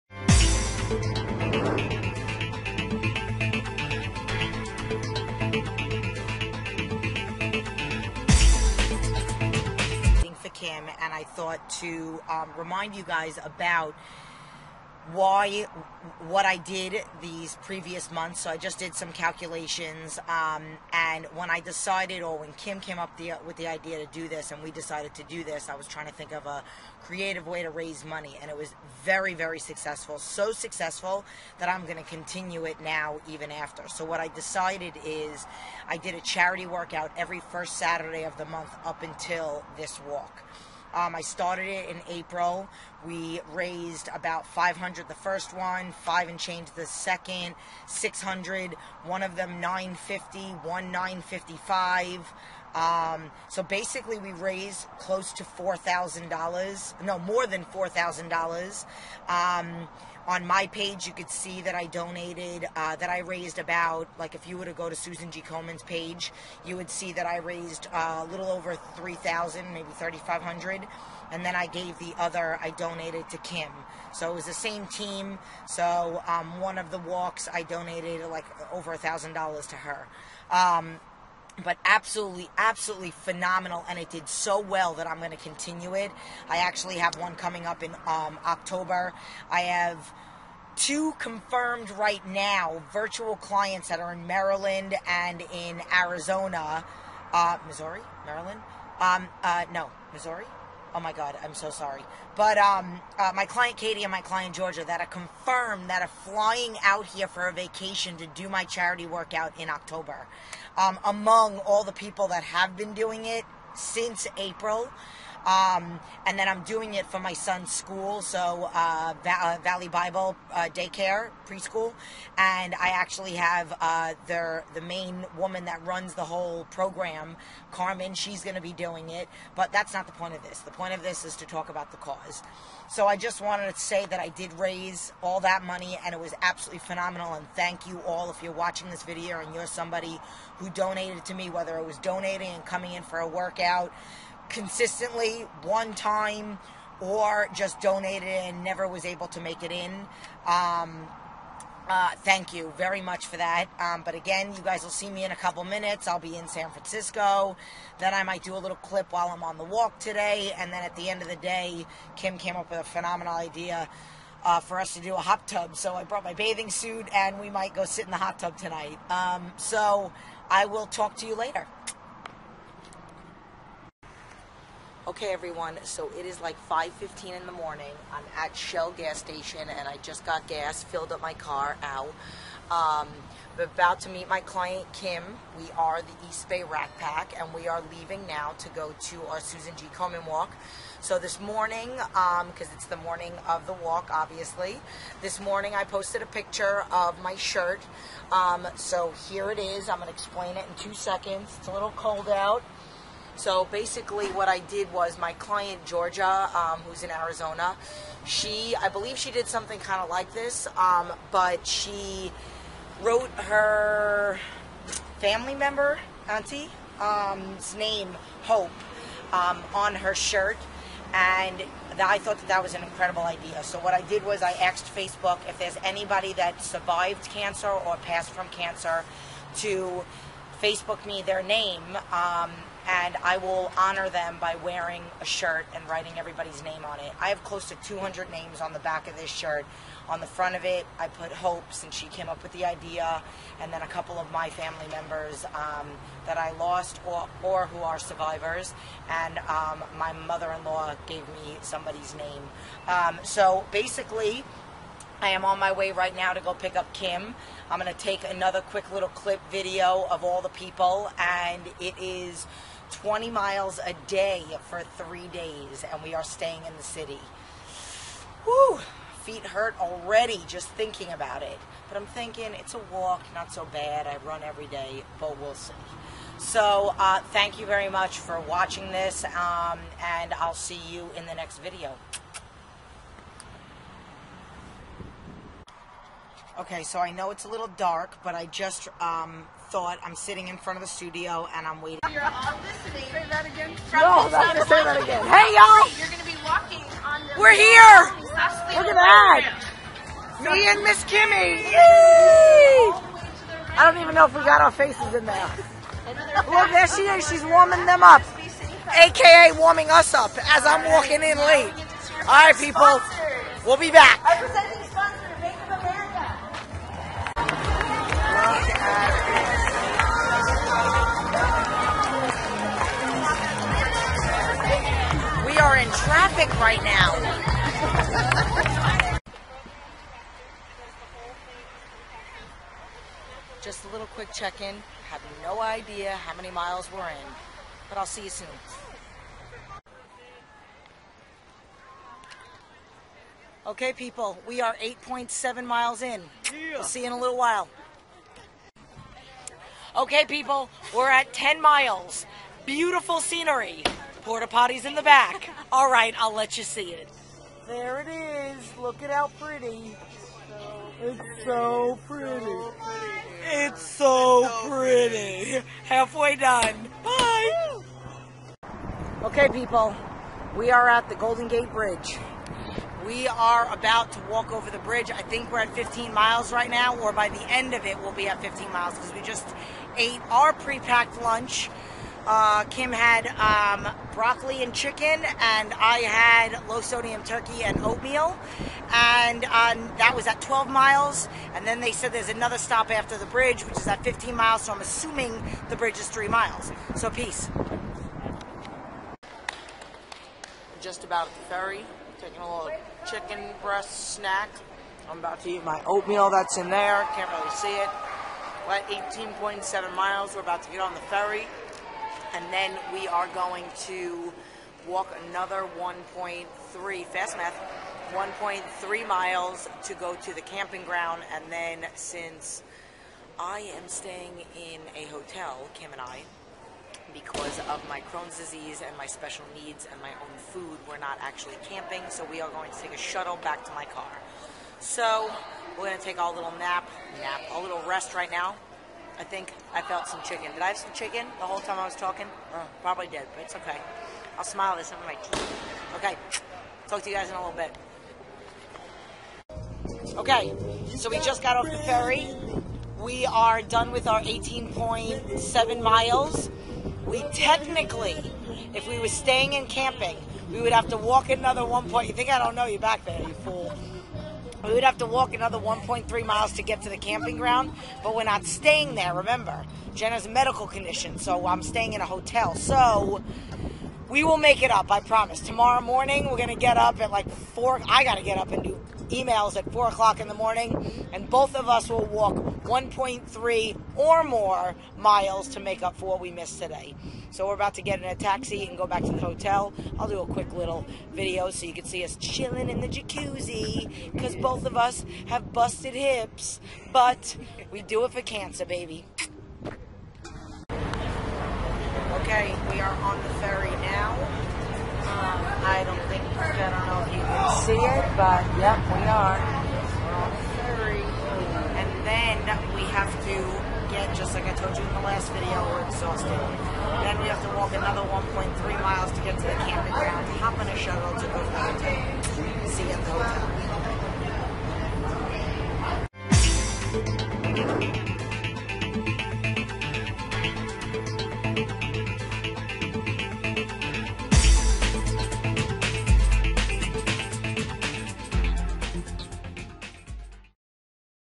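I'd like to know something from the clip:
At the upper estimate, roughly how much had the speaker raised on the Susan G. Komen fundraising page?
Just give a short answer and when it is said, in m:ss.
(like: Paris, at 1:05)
3500, at 1:09.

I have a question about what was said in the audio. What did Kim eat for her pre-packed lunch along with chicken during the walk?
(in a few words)
Broccoli.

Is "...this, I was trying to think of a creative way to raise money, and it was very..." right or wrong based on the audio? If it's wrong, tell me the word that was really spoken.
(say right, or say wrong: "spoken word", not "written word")
right.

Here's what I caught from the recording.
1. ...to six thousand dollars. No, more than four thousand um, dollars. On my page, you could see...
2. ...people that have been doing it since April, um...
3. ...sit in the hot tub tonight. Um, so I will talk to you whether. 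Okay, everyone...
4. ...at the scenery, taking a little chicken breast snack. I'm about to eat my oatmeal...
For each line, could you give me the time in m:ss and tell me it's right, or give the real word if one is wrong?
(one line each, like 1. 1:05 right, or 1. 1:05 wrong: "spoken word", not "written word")
1. 0:55 wrong: "four", not "six"
2. 1:51 right
3. 2:47 wrong: "later", not "whether"
4. 6:41 wrong: "ferry", not "scenery".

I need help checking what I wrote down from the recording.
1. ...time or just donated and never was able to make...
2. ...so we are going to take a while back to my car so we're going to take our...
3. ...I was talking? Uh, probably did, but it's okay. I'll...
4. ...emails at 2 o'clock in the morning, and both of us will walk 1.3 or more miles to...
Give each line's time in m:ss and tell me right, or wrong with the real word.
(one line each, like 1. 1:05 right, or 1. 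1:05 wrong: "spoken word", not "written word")
1. 2:25 right
2. 7:12 wrong: "shuttle", not "while"
3. 7:21 right
4. 7:59 wrong: "4", not "2".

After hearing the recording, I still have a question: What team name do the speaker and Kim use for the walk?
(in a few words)
East Bay Rack Pack.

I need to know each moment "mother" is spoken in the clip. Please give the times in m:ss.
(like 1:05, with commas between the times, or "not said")
4:10.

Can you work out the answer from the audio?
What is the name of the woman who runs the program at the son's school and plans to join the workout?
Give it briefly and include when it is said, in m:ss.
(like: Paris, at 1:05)
Carmen, at 2:07.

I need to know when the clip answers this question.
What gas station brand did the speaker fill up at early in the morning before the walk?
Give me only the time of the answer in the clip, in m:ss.
2:58.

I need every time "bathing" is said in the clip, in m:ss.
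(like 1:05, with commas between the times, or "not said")
2:46.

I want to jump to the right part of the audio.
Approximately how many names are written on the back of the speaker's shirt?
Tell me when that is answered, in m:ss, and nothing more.
3:57.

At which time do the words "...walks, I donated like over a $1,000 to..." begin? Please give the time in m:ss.
1:16.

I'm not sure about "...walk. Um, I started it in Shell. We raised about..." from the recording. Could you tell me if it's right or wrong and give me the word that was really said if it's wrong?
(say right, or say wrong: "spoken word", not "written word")
wrong: "April", not "Shell".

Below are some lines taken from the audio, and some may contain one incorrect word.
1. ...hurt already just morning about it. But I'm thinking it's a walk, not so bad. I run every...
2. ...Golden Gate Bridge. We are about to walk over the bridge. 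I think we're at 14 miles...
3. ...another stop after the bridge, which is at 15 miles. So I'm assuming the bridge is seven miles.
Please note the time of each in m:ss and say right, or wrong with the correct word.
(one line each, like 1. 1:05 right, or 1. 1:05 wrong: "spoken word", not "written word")
1. 4:29 wrong: "thinking", not "morning"
2. 6:11 wrong: "15", not "14"
3. 6:32 wrong: "three", not "seven".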